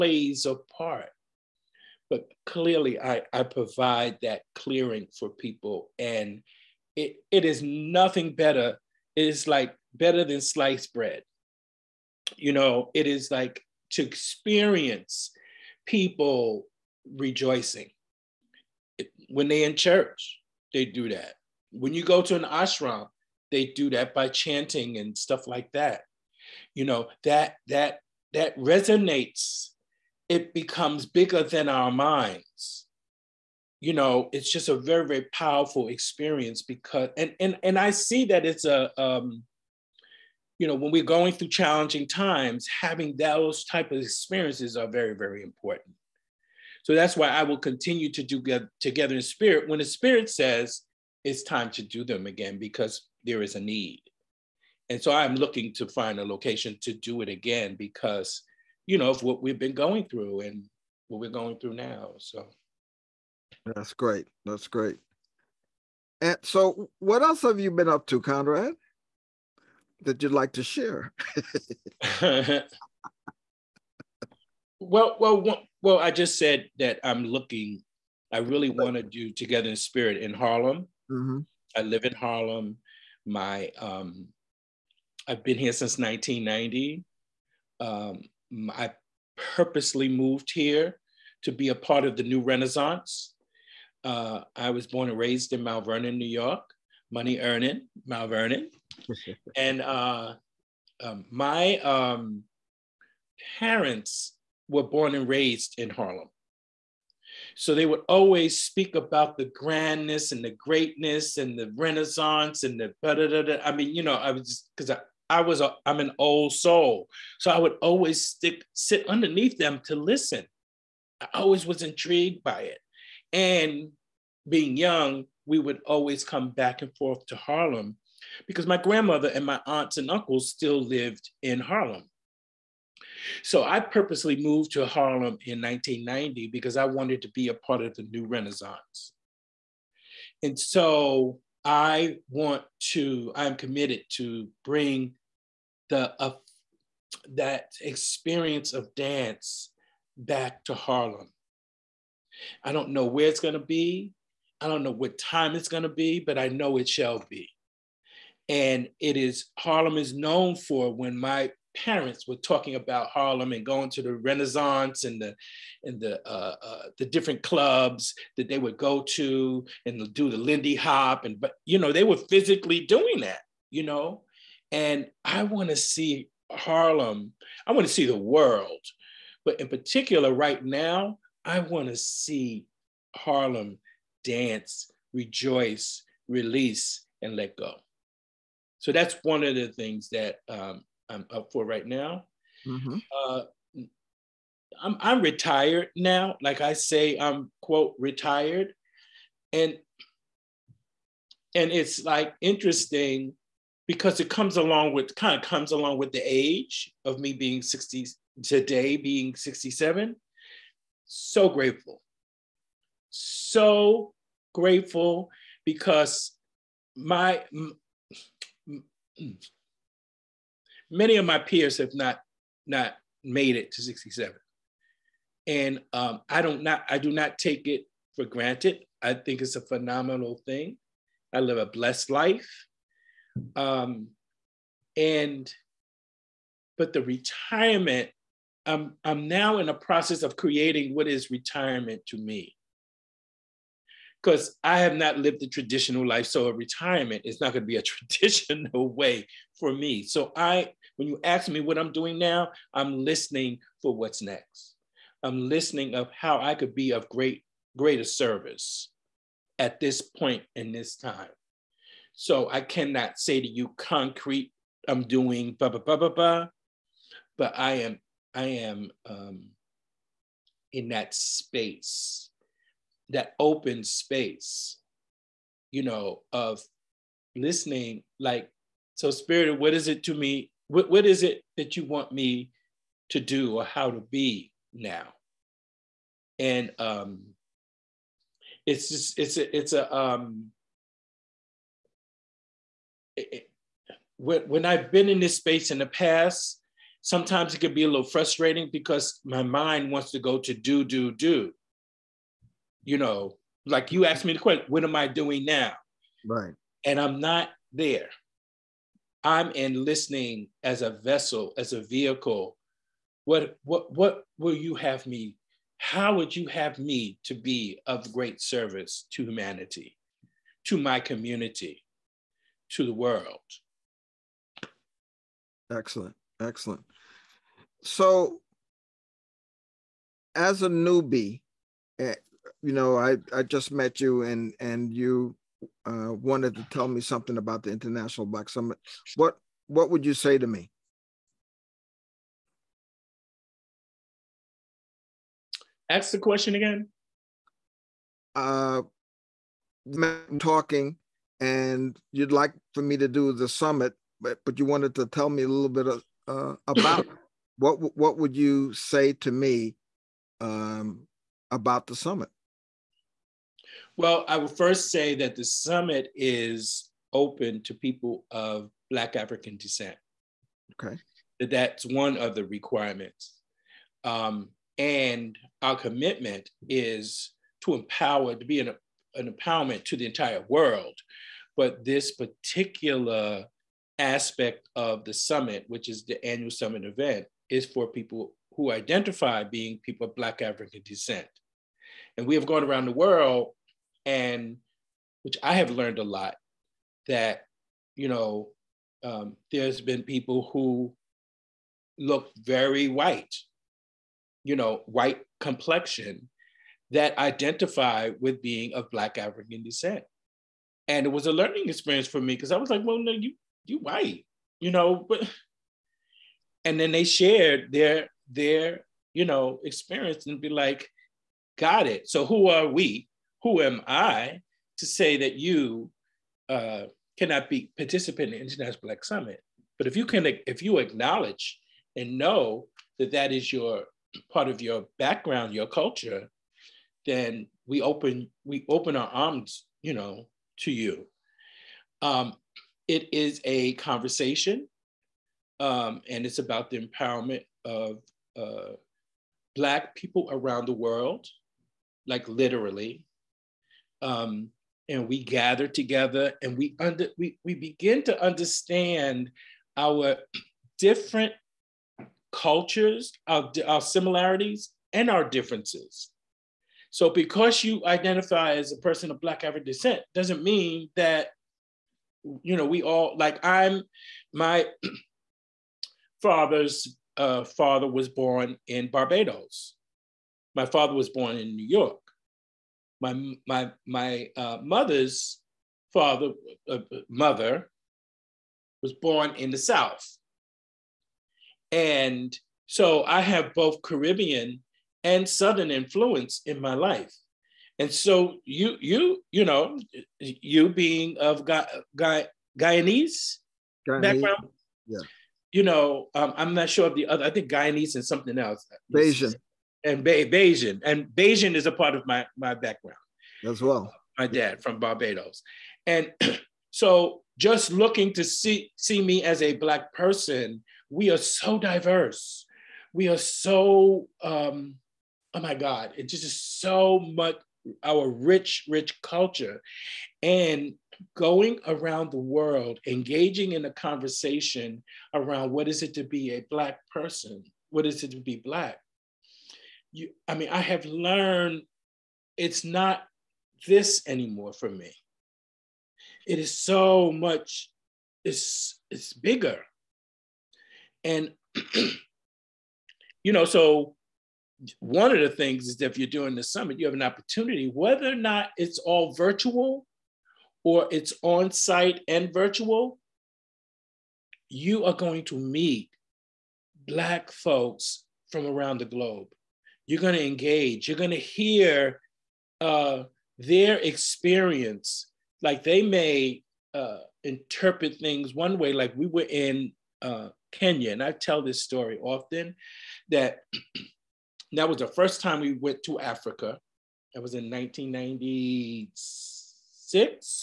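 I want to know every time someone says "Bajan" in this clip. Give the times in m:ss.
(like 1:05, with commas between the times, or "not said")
8:28.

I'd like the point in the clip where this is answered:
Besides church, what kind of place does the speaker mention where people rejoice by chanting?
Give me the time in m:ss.
0:22.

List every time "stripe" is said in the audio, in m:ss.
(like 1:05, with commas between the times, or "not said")
not said.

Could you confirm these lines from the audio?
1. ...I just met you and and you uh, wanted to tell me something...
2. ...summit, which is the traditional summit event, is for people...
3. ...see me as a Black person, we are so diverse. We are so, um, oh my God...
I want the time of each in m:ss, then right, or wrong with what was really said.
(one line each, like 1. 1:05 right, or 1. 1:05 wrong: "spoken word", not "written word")
1. 5:33 right
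2. 6:25 wrong: "annual", not "traditional"
3. 8:38 right.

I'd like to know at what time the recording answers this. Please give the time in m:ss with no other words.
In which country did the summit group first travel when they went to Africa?
9:40.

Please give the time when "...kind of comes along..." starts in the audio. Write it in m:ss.
3:25.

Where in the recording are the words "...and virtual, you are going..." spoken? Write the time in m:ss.
9:22.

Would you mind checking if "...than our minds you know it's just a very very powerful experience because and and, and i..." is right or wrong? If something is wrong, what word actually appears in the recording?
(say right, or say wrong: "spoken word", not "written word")
right.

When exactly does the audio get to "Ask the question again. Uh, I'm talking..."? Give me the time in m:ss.
5:45.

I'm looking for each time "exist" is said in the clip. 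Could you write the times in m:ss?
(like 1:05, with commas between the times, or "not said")
not said.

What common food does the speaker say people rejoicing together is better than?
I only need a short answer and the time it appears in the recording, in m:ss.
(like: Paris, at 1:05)
sliced bread, at 0:10.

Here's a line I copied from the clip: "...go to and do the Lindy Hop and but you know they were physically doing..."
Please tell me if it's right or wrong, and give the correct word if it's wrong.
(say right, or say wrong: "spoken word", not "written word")
right.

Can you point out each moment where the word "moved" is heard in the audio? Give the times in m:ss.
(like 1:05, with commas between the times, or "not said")
1:30, 2:14.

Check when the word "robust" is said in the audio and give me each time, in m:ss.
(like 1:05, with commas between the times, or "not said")
not said.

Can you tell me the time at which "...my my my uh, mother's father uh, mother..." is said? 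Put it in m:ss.
8:02.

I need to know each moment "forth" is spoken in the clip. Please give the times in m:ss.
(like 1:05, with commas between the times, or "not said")
2:06.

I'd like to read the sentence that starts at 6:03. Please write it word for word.
Well, I will first say that the summit is open to people of Black African descent.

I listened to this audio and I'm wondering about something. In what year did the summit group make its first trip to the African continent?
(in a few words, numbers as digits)
1996.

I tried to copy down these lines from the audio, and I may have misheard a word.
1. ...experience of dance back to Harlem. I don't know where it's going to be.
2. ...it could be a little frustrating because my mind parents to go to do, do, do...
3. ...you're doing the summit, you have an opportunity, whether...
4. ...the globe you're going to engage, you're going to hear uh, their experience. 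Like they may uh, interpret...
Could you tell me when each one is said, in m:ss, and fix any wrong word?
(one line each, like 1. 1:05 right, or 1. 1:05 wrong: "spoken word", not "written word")
1. 2:27 right
2. 4:57 wrong: "wants", not "parents"
3. 9:15 right
4. 9:28 right.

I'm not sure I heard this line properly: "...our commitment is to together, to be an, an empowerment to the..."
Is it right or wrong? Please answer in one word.
wrong.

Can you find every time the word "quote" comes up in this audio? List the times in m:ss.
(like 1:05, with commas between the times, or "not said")
3:17.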